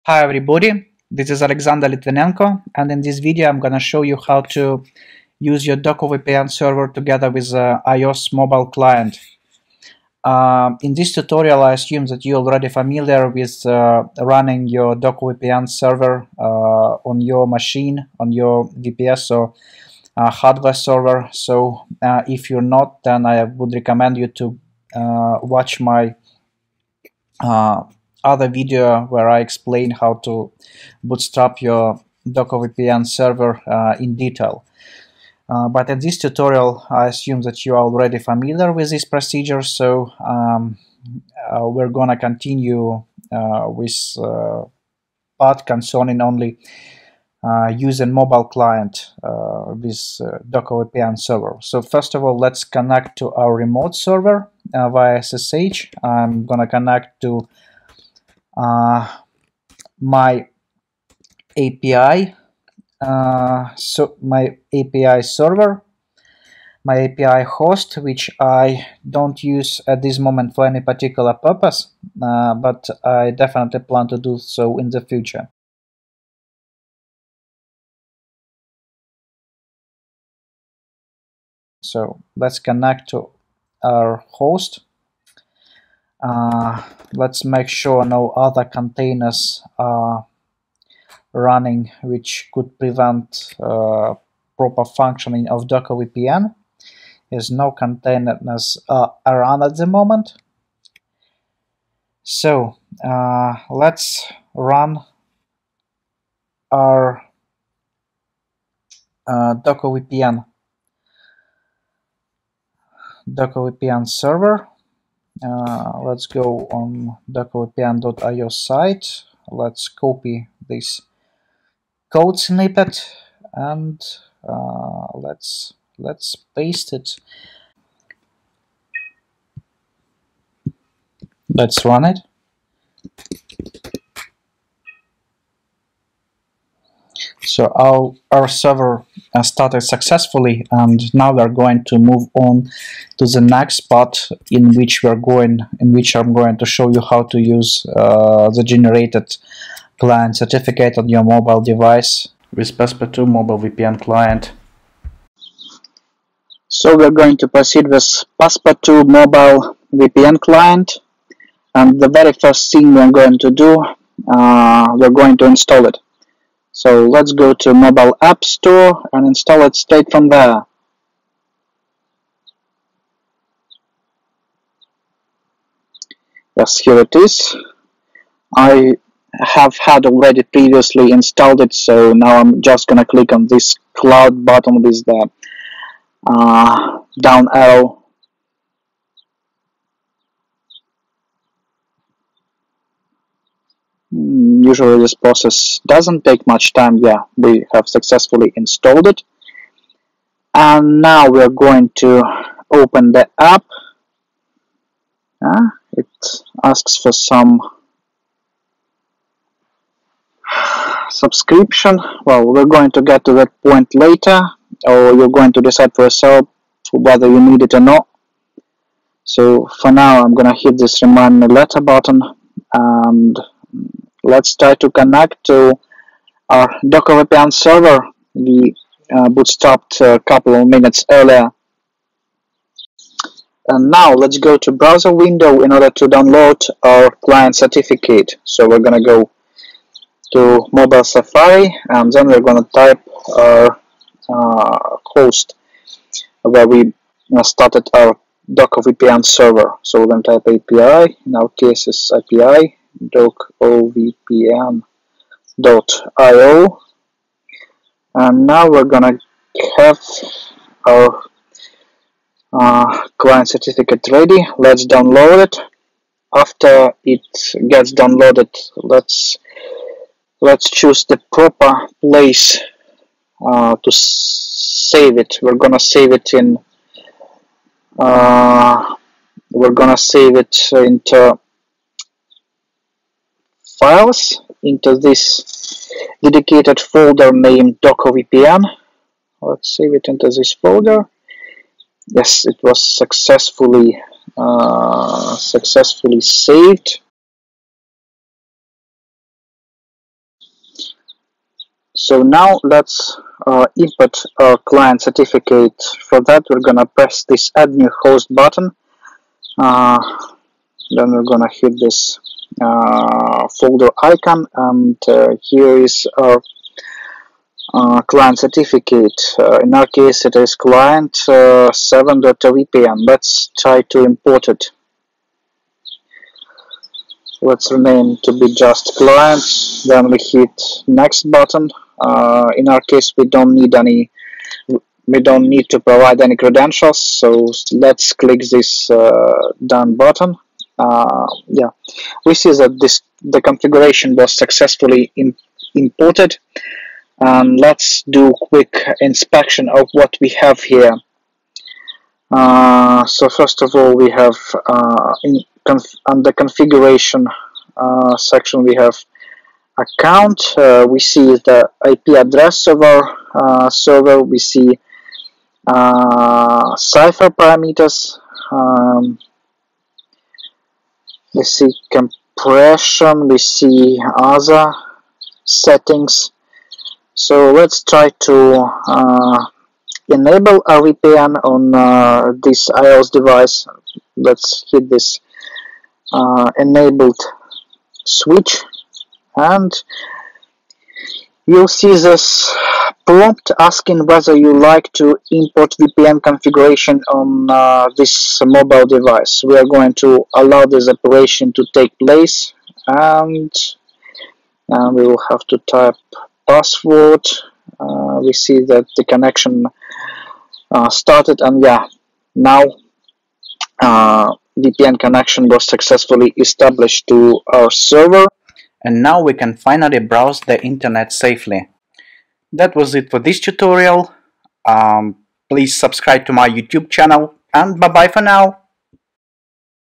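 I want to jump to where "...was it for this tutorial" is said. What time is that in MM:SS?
07:02.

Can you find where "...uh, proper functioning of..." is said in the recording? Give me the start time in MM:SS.
01:33.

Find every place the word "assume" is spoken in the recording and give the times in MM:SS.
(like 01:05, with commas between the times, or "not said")
00:11, 00:37.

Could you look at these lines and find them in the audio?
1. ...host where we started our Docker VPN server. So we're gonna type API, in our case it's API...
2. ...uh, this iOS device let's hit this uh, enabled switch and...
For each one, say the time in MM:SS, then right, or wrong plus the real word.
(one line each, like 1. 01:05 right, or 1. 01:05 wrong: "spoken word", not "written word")
1. 04:05 right
2. 06:21 right.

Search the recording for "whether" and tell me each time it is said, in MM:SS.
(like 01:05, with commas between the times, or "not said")
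03:36, 06:34.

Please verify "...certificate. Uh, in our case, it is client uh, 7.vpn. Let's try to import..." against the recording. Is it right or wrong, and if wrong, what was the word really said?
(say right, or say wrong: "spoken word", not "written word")
right.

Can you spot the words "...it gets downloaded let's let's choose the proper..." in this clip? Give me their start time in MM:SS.
04:27.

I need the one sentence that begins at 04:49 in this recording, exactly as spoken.
Let's save it into this folder.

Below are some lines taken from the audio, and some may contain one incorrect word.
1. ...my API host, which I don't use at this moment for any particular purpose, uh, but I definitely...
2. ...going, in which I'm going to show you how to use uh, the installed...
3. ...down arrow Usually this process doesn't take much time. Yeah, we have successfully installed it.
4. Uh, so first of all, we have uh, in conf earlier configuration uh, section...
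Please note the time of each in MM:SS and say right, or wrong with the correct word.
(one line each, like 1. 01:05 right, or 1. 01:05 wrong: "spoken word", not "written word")
1. 01:06 right
2. 02:25 wrong: "generated", not "installed"
3. 03:07 right
4. 05:52 wrong: "under", not "earlier".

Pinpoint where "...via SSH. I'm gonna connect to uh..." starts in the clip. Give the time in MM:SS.
00:54.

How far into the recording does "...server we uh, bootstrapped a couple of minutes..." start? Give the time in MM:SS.
03:47.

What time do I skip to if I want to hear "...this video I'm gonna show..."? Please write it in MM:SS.
00:03.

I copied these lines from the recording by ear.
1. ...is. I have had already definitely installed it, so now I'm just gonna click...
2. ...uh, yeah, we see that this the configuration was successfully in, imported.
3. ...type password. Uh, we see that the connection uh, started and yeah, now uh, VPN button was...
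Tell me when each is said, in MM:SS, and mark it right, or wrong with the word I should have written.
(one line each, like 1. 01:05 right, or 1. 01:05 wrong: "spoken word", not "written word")
1. 02:57 wrong: "previously", not "definitely"
2. 05:40 right
3. 06:45 wrong: "connection", not "button".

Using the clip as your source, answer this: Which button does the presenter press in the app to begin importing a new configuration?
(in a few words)
Add New Host.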